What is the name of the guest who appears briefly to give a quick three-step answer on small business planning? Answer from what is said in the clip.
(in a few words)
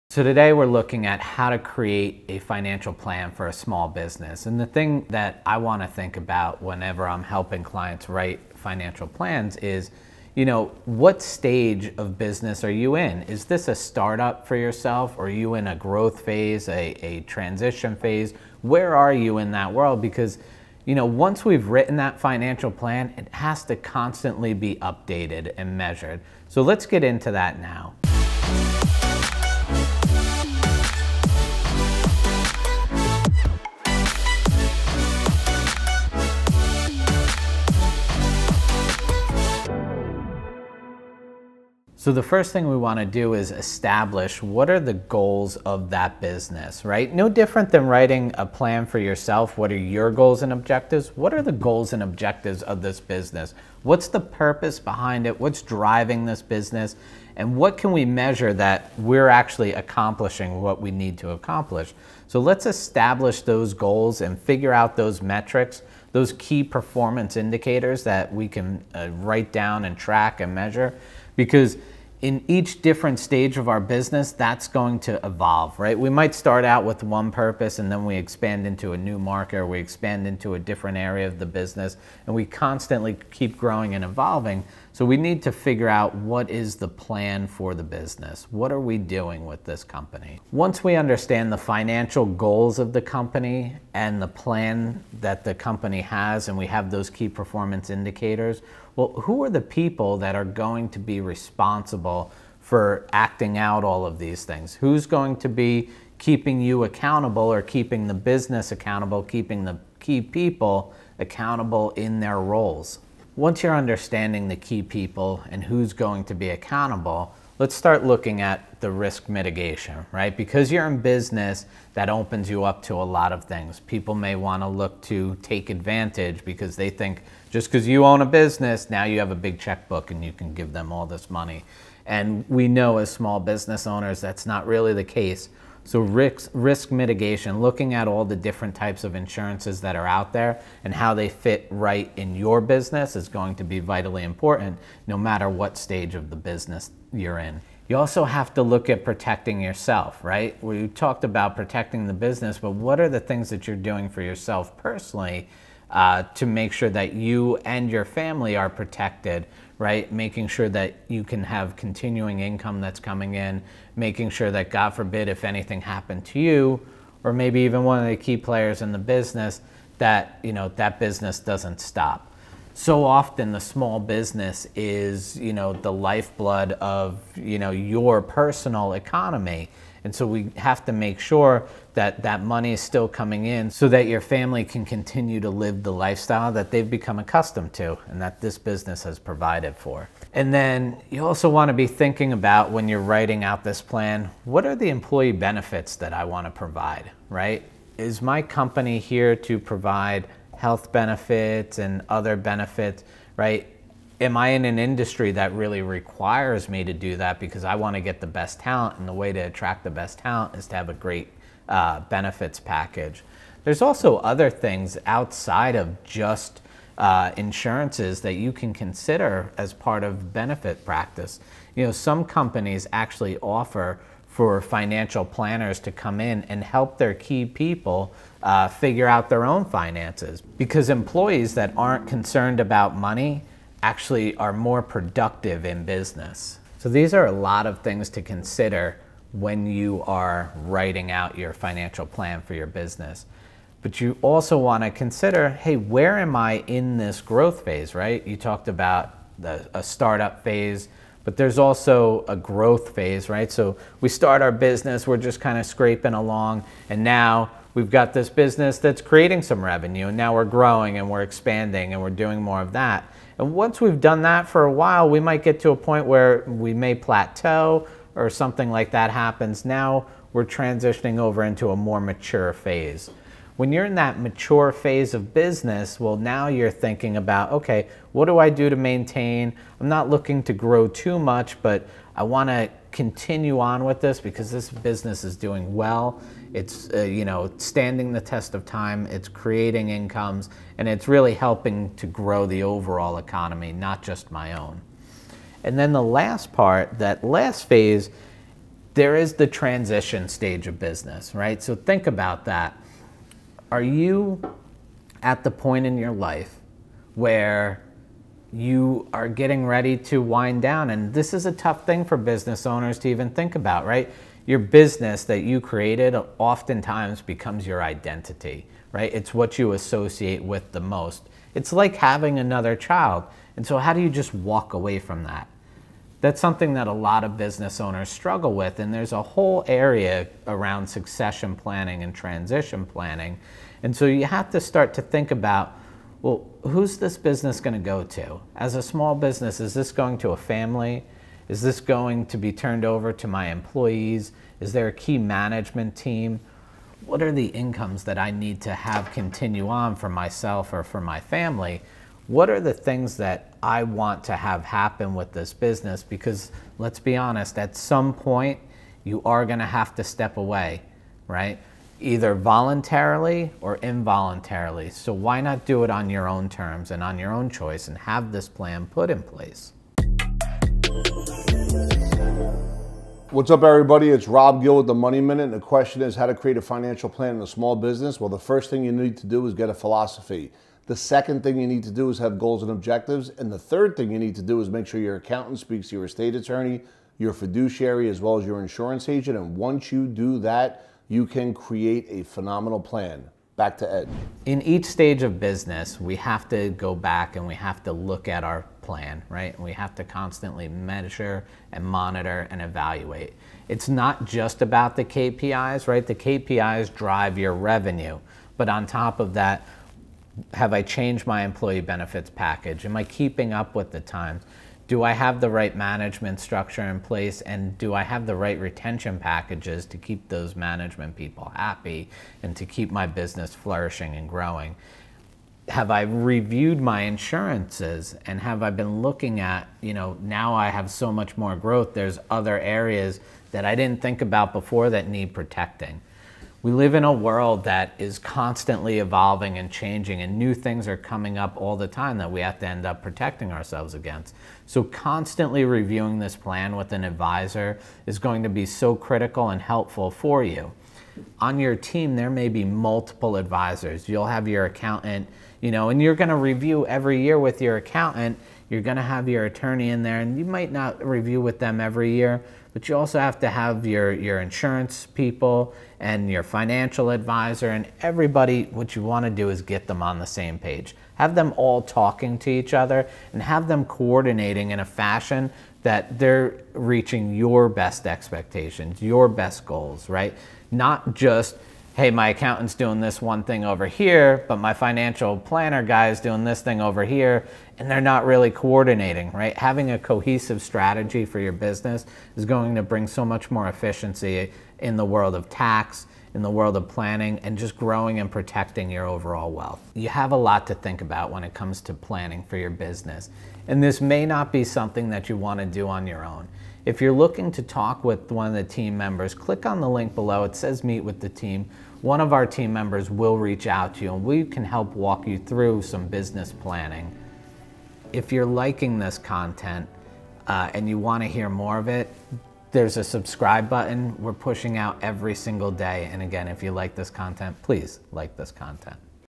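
Rob Gill.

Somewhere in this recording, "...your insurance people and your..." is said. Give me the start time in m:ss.
7:44.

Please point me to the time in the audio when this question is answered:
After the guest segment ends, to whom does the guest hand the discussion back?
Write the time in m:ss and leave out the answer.
6:33.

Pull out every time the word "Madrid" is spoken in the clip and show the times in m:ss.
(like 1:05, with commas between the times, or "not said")
not said.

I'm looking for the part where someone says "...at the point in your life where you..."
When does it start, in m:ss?
5:05.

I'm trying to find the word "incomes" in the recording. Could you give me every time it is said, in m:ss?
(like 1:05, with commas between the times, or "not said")
2:42, 4:49, 5:47.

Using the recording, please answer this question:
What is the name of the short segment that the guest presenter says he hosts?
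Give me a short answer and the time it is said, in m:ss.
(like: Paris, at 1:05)
the Money Minute, at 6:14.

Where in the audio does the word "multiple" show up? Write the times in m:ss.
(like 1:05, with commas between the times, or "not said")
7:32.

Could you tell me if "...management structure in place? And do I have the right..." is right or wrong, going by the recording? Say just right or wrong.
right.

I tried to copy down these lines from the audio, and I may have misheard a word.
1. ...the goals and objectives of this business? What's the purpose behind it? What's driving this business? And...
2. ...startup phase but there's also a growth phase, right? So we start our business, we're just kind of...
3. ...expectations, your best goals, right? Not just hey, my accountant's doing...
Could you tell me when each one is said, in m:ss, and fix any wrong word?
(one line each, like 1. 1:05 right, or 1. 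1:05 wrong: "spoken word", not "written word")
1. 0:51 right
2. 4:09 right
3. 7:58 right.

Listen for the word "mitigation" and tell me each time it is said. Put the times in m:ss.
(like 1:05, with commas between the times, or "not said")
1:59, 2:16.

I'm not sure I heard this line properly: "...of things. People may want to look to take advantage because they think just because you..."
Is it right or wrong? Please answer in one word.
right.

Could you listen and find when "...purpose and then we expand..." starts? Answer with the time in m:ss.
1:17.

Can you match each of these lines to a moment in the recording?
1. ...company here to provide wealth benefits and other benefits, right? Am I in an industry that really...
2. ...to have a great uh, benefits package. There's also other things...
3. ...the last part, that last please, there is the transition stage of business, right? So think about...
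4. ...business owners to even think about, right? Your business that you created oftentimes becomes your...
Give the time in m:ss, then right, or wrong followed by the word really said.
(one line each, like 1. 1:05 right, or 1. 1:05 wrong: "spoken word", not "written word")
1. 3:18 wrong: "health", not "wealth"
2. 3:30 right
3. 4:55 wrong: "phase", not "please"
4. 5:12 right.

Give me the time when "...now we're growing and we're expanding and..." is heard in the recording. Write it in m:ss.
4:20.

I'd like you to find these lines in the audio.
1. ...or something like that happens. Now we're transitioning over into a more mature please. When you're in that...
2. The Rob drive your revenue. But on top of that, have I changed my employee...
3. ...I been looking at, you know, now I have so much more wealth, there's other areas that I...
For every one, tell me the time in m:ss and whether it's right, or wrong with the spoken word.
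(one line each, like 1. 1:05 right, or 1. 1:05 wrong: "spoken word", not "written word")
1. 4:28 wrong: "phase", not "please"
2. 6:46 wrong: "KPIs", not "Rob"
3. 7:08 wrong: "growth", not "wealth".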